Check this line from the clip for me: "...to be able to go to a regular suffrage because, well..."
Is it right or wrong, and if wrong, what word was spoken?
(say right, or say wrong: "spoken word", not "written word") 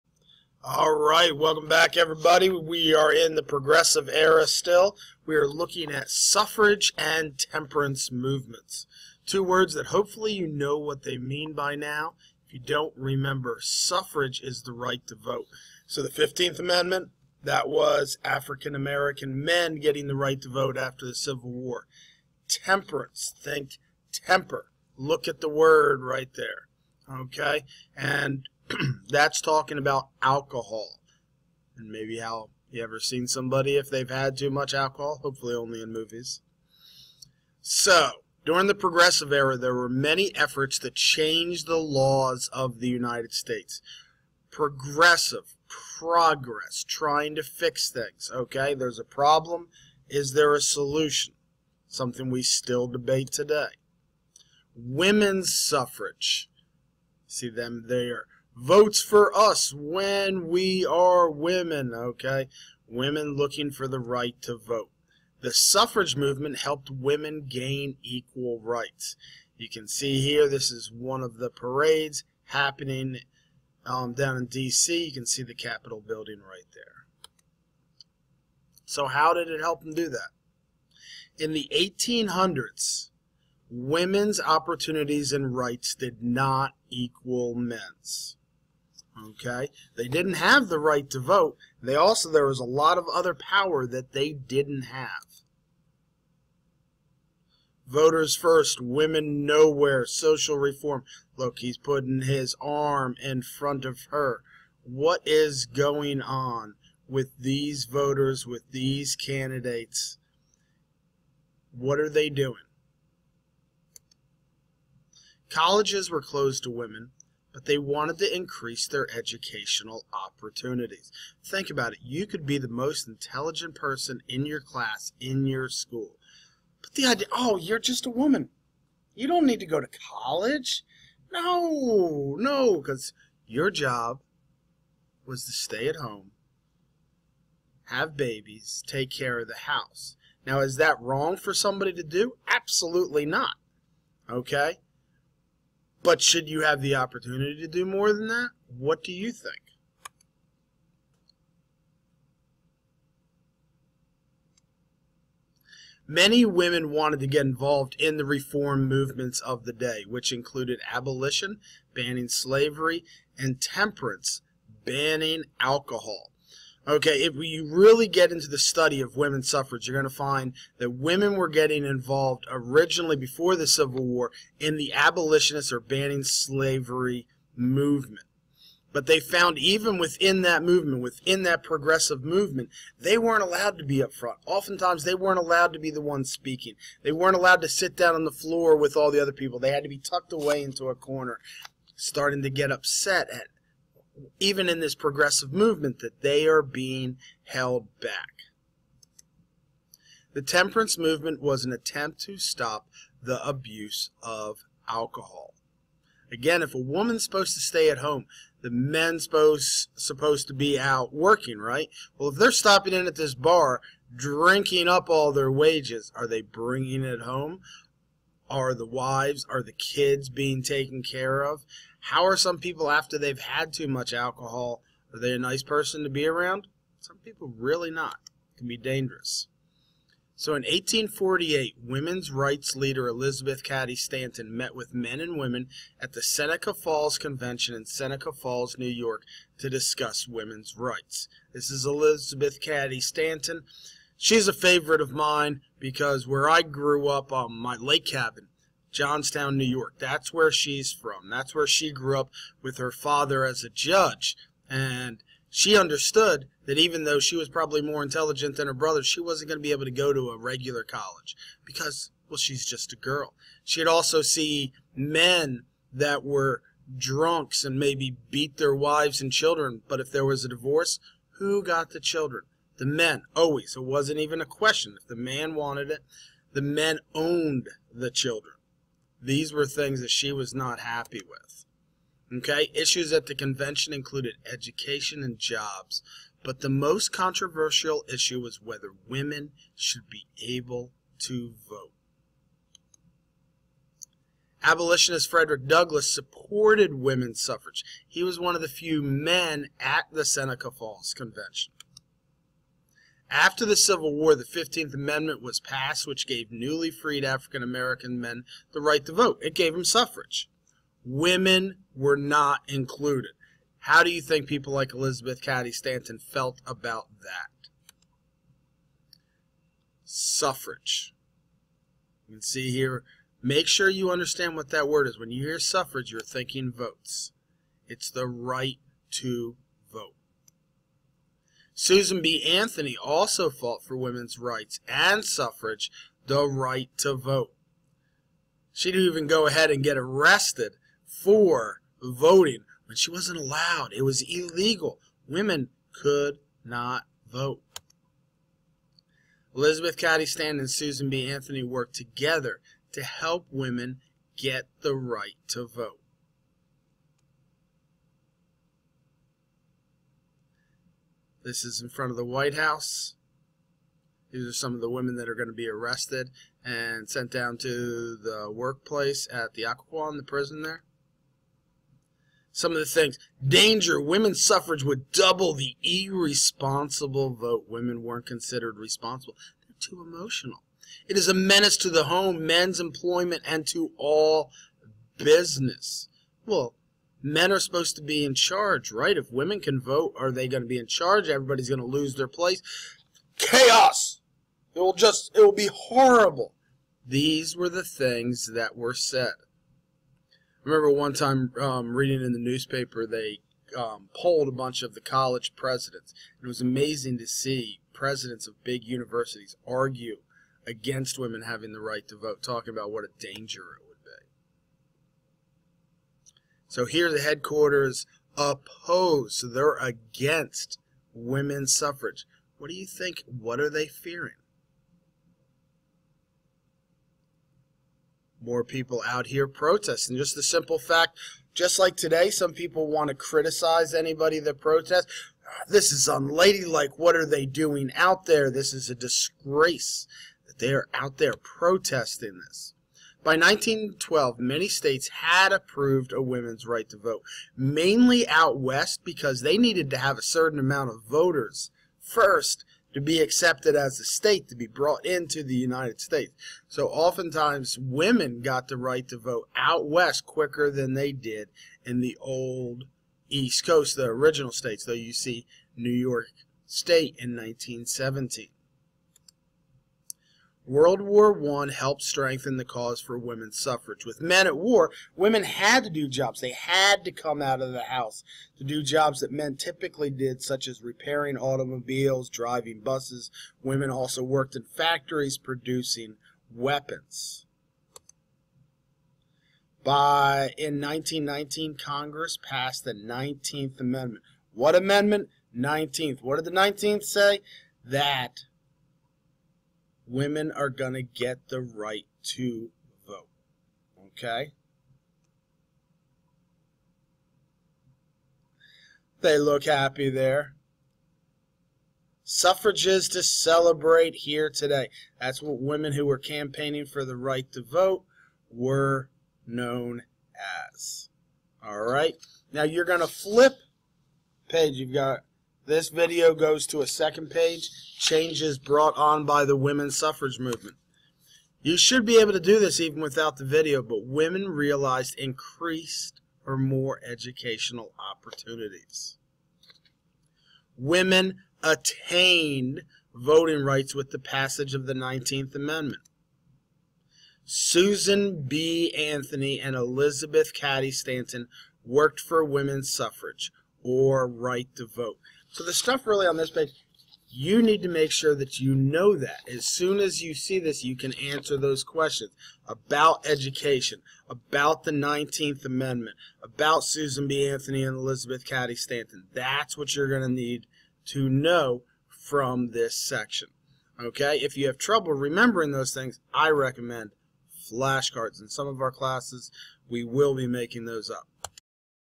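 wrong: "college", not "suffrage".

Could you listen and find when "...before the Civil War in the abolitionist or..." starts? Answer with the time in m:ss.
2:53.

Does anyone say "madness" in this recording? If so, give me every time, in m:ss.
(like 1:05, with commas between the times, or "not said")
not said.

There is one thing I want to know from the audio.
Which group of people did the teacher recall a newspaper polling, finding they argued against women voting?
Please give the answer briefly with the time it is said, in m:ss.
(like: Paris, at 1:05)
College presidents, at 6:45.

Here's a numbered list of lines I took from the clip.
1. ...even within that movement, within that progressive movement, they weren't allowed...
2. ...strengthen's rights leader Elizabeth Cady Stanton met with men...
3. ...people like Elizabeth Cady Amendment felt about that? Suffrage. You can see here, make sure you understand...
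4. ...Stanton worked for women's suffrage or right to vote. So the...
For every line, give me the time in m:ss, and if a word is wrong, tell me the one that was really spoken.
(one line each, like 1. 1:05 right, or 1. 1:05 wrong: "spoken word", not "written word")
1. 2:59 right
2. 3:51 wrong: "women", not "strengthen"
3. 5:14 wrong: "Stanton", not "Amendment"
4. 9:10 right.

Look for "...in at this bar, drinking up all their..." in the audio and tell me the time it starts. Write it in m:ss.
3:32.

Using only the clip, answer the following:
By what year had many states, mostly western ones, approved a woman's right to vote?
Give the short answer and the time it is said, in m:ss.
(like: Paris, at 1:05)
1912, at 7:23.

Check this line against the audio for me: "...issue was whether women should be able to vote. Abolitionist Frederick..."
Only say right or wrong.
right.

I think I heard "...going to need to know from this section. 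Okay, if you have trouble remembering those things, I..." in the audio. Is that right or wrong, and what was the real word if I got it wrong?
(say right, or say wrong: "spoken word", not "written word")
right.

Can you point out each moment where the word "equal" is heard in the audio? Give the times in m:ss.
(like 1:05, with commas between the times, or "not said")
1:08, 1:26.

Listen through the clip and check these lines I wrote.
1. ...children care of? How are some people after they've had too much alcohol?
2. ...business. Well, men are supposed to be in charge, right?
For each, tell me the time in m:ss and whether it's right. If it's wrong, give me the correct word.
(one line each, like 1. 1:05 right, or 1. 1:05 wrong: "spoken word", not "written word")
1. 3:40 wrong: "taken", not "children"
2. 6:25 right.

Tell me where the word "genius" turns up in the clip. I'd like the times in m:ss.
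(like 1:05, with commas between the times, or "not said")
not said.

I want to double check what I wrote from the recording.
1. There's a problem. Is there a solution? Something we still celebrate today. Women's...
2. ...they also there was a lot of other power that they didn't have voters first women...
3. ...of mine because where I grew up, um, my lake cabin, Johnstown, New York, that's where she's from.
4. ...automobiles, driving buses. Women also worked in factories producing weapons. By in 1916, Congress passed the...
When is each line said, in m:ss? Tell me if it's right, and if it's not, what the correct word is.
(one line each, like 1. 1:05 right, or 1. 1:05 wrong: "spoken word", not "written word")
1. 0:48 wrong: "debate", not "celebrate"
2. 1:31 right
3. 4:05 right
4. 8:01 wrong: "1919", not "1916".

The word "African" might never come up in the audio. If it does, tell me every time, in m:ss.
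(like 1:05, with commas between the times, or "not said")
0:18, 5:07.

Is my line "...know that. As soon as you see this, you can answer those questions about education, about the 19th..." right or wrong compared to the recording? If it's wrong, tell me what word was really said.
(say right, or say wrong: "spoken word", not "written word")
right.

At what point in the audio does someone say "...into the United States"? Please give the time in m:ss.
7:35.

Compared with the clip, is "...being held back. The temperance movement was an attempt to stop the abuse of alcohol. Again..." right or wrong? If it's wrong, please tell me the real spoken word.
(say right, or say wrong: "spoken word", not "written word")
right.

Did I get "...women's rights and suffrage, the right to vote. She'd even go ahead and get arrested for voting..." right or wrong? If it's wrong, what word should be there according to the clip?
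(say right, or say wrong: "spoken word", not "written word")
right.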